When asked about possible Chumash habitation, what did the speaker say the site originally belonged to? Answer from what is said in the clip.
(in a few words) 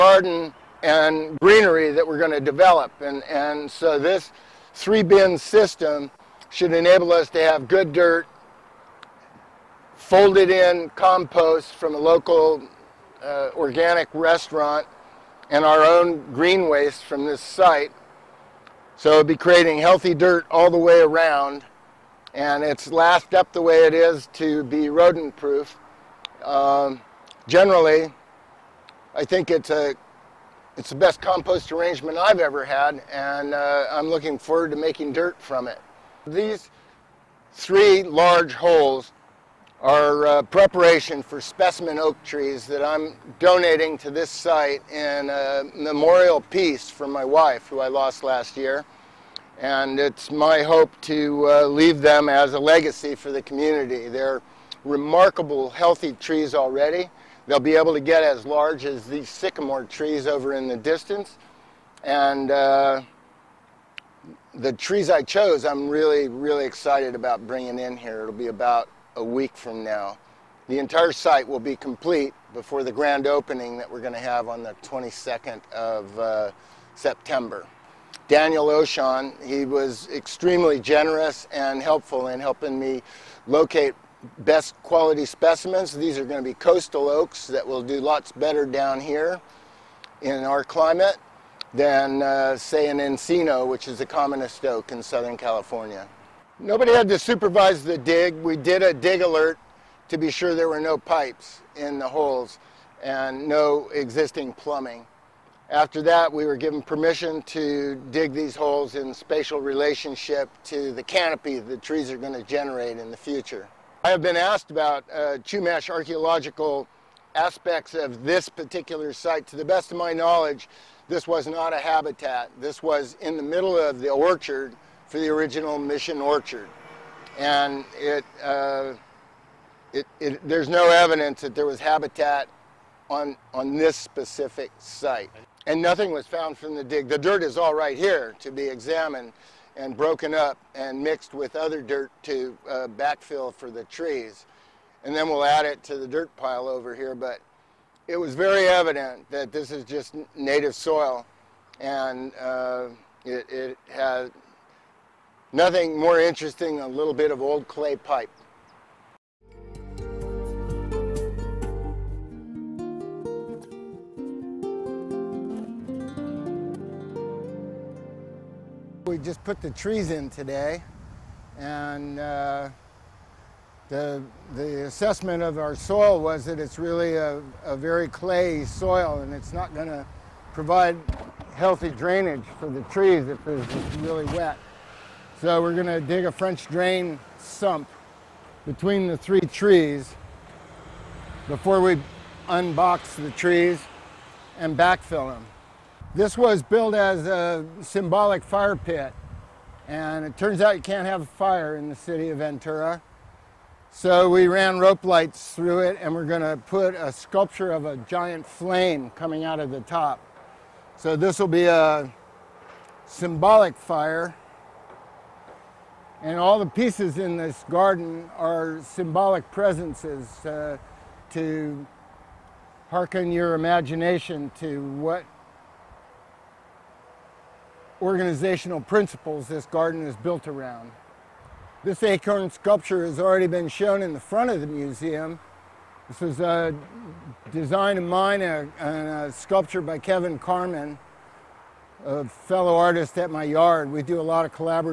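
Mission Orchard.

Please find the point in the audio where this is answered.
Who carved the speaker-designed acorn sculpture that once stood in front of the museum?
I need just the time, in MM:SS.
03:59.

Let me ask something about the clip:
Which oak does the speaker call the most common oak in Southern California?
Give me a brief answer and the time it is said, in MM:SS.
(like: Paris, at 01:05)
Encino, at 01:32.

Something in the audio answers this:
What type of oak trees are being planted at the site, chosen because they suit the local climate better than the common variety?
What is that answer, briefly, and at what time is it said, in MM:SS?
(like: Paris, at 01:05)
Coastal oaks, at 01:26.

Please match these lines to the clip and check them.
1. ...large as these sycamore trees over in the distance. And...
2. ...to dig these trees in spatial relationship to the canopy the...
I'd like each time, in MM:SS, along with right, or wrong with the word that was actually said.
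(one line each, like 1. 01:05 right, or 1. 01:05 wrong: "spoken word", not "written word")
1. 00:58 right
2. 01:47 wrong: "holes", not "trees".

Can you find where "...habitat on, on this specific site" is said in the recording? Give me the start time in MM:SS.
02:11.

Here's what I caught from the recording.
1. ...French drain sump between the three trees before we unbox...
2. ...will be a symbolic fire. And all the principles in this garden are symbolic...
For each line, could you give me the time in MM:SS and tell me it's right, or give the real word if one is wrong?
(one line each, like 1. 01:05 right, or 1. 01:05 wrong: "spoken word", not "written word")
1. 03:06 right
2. 03:31 wrong: "pieces", not "principles".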